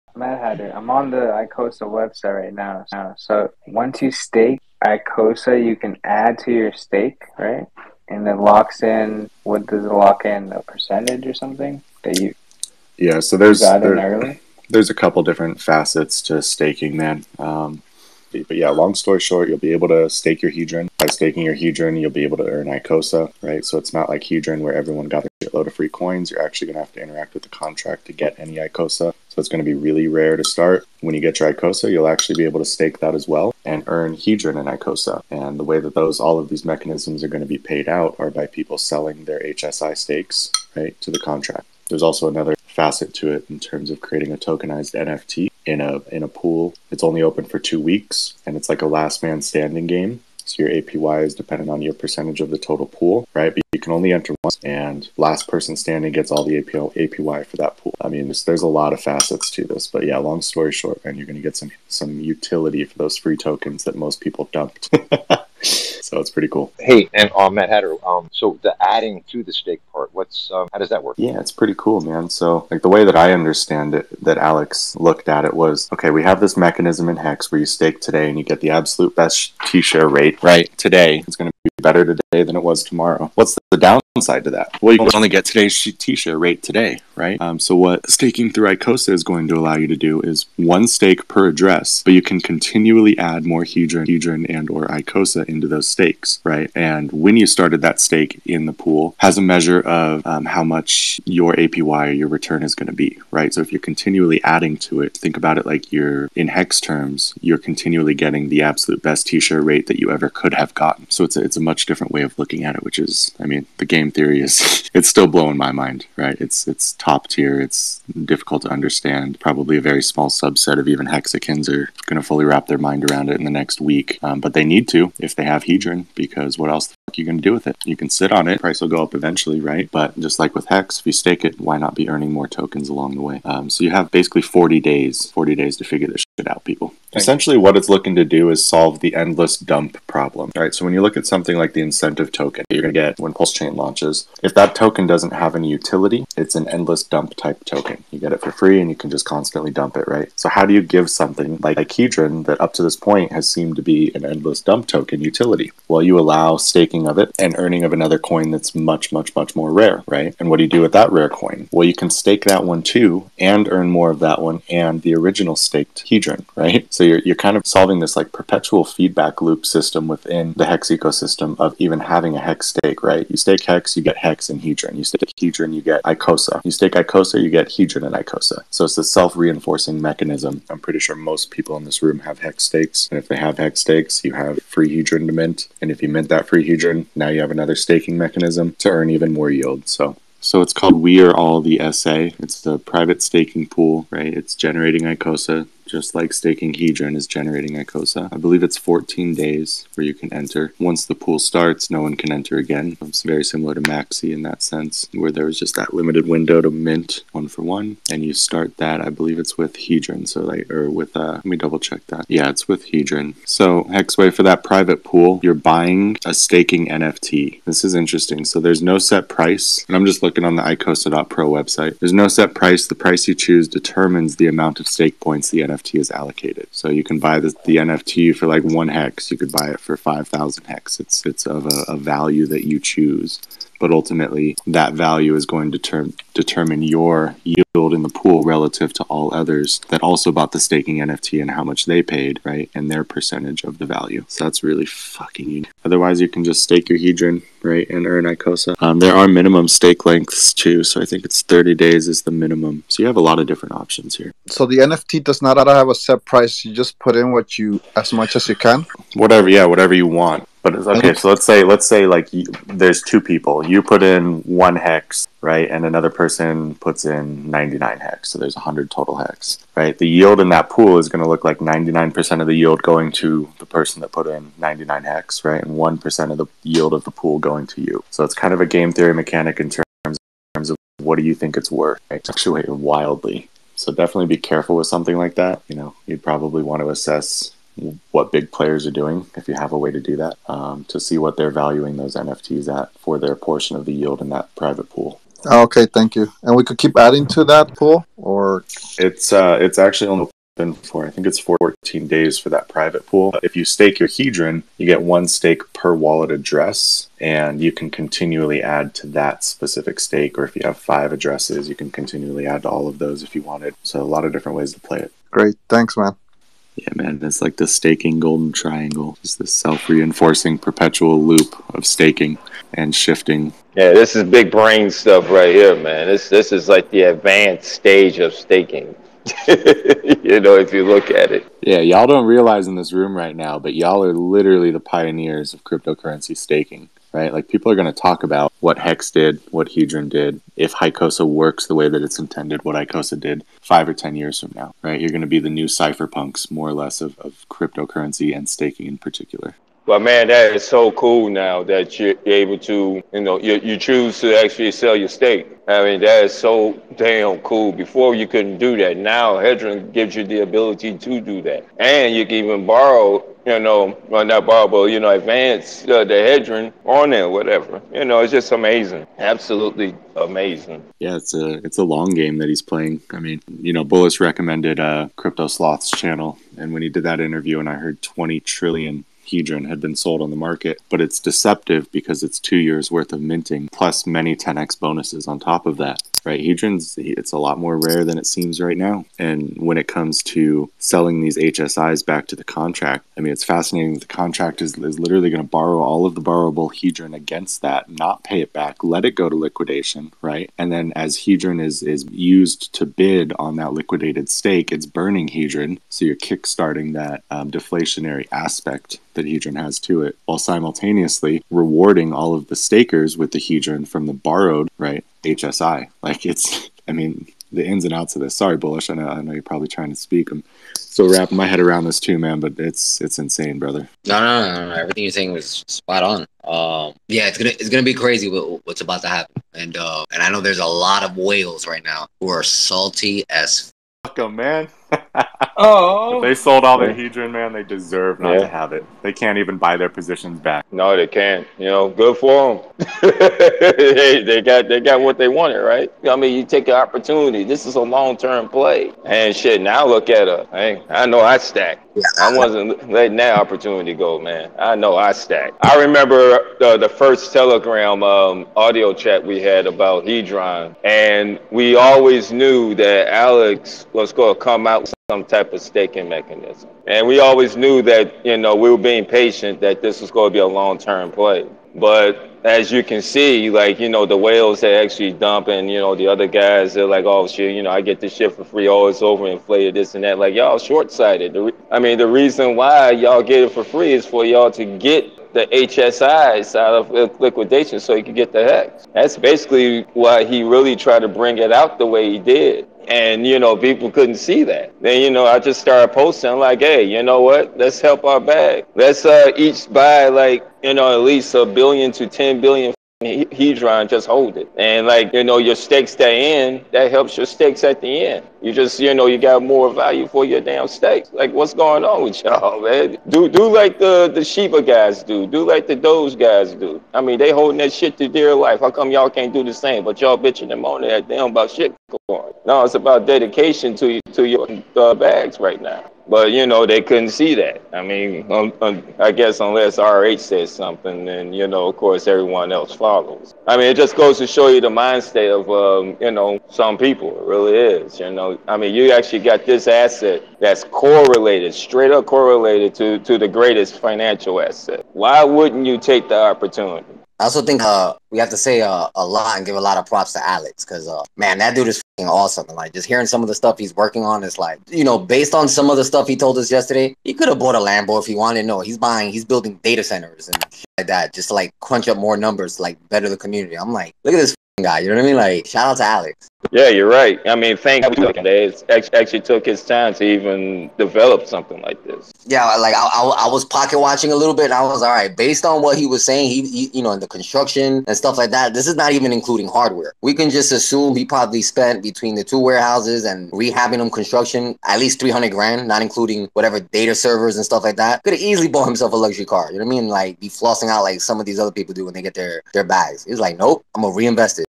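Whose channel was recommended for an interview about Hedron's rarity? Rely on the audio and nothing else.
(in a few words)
Crypto Sloth.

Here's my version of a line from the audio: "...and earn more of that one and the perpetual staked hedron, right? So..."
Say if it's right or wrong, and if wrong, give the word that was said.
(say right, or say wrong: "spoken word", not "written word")
wrong: "original", not "perpetual".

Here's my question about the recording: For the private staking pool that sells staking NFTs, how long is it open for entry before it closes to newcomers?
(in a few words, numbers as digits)
14 days.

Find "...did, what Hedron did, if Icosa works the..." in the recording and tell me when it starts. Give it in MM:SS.
05:39.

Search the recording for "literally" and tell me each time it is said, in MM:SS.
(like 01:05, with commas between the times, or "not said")
05:34, 06:34.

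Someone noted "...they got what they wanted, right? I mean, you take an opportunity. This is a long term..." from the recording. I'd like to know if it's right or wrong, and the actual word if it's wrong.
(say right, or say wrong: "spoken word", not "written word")
right.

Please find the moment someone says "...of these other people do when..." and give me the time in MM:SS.
09:51.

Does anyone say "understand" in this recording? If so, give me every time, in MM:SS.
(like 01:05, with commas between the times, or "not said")
01:13, 01:58.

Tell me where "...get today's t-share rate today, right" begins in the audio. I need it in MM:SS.
01:25.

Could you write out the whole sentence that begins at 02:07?
You can sit on it, price will go up eventually, right?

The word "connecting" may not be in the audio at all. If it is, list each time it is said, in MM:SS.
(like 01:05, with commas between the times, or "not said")
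not said.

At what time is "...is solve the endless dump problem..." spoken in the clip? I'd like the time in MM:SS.
02:18.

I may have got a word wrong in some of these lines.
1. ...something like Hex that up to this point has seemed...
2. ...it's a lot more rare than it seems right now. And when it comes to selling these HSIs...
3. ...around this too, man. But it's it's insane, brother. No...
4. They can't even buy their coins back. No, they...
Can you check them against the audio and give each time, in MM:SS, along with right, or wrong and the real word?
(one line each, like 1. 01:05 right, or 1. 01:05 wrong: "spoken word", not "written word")
1. 02:31 wrong: "Hedron", not "Hex"
2. 06:27 right
3. 07:01 right
4. 07:19 wrong: "positions", not "coins".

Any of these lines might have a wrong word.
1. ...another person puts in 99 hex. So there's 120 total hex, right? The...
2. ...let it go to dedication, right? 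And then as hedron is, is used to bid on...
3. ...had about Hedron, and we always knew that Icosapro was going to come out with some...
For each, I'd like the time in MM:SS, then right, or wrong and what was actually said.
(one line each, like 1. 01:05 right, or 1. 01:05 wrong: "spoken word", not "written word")
1. 04:25 wrong: "100", not "120"
2. 06:38 wrong: "liquidation", not "dedication"
3. 07:39 wrong: "Alex", not "Icosapro".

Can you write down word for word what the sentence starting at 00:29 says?
So it's going to be really rare to start.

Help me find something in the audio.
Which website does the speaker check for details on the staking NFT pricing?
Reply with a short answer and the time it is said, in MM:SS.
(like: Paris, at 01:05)
Icosa.pro, at 03:40.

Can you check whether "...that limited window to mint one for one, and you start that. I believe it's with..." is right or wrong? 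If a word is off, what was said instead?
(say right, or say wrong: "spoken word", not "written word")
right.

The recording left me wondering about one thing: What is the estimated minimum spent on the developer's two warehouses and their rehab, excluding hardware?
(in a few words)
300 grand.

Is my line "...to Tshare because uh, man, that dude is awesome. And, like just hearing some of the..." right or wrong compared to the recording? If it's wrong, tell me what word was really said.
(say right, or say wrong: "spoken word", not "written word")
wrong: "Alex", not "Tshare".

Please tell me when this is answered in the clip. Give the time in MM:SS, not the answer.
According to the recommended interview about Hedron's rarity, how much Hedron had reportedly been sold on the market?
06:18.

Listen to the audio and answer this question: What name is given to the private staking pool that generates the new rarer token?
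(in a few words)
We Are All the SA.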